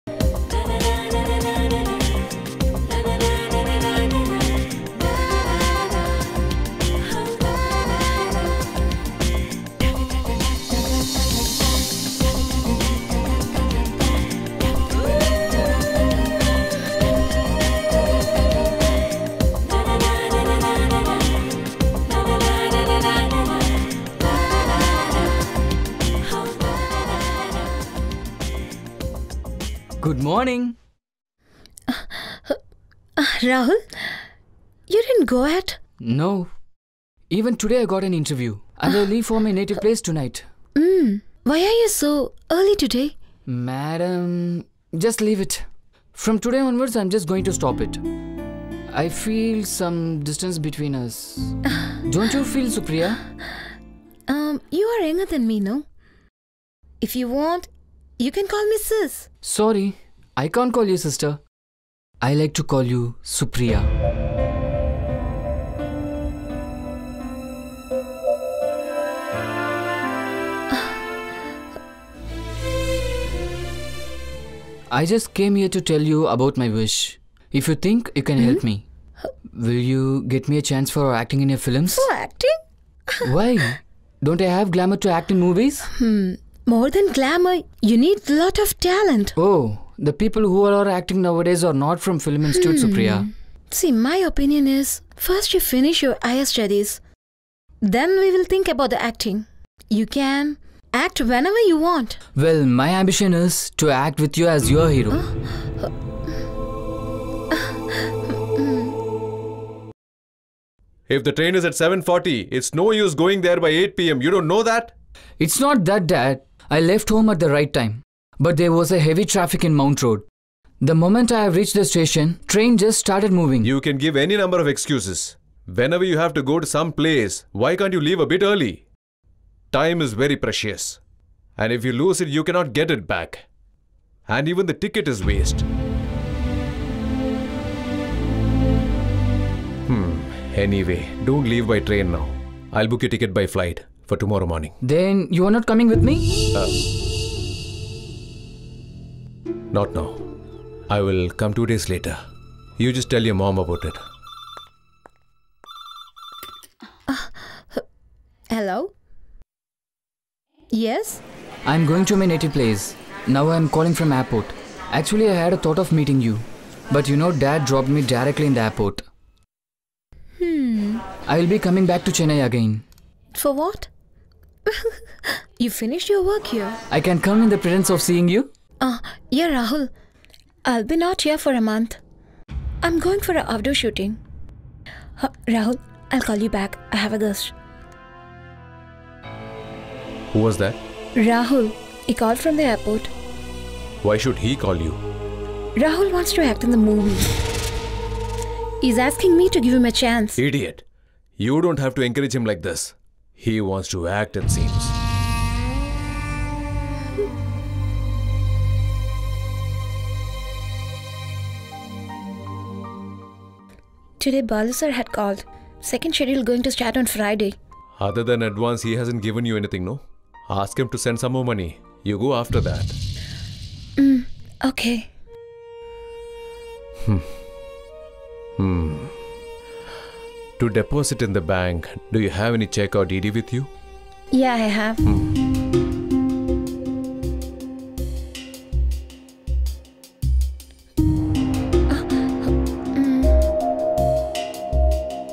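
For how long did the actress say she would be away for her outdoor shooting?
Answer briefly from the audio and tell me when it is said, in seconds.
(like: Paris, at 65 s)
A month, at 181 s.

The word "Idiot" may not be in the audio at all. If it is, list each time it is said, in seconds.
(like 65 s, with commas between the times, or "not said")
200 s.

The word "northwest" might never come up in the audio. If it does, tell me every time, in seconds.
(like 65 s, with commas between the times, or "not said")
not said.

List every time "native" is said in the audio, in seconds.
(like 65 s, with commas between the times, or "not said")
39 s, 162 s.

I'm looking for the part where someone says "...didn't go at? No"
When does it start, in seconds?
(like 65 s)
35 s.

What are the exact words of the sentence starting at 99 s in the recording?
You can act whenever you want.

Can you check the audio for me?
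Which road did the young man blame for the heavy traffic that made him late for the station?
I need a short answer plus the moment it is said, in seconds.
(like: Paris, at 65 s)
Mount Road, at 119 s.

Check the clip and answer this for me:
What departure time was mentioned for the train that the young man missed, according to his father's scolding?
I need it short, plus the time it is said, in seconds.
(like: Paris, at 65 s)
7:40, at 111 s.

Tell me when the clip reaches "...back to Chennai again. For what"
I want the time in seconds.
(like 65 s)
171 s.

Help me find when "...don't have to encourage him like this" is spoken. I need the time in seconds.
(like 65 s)
201 s.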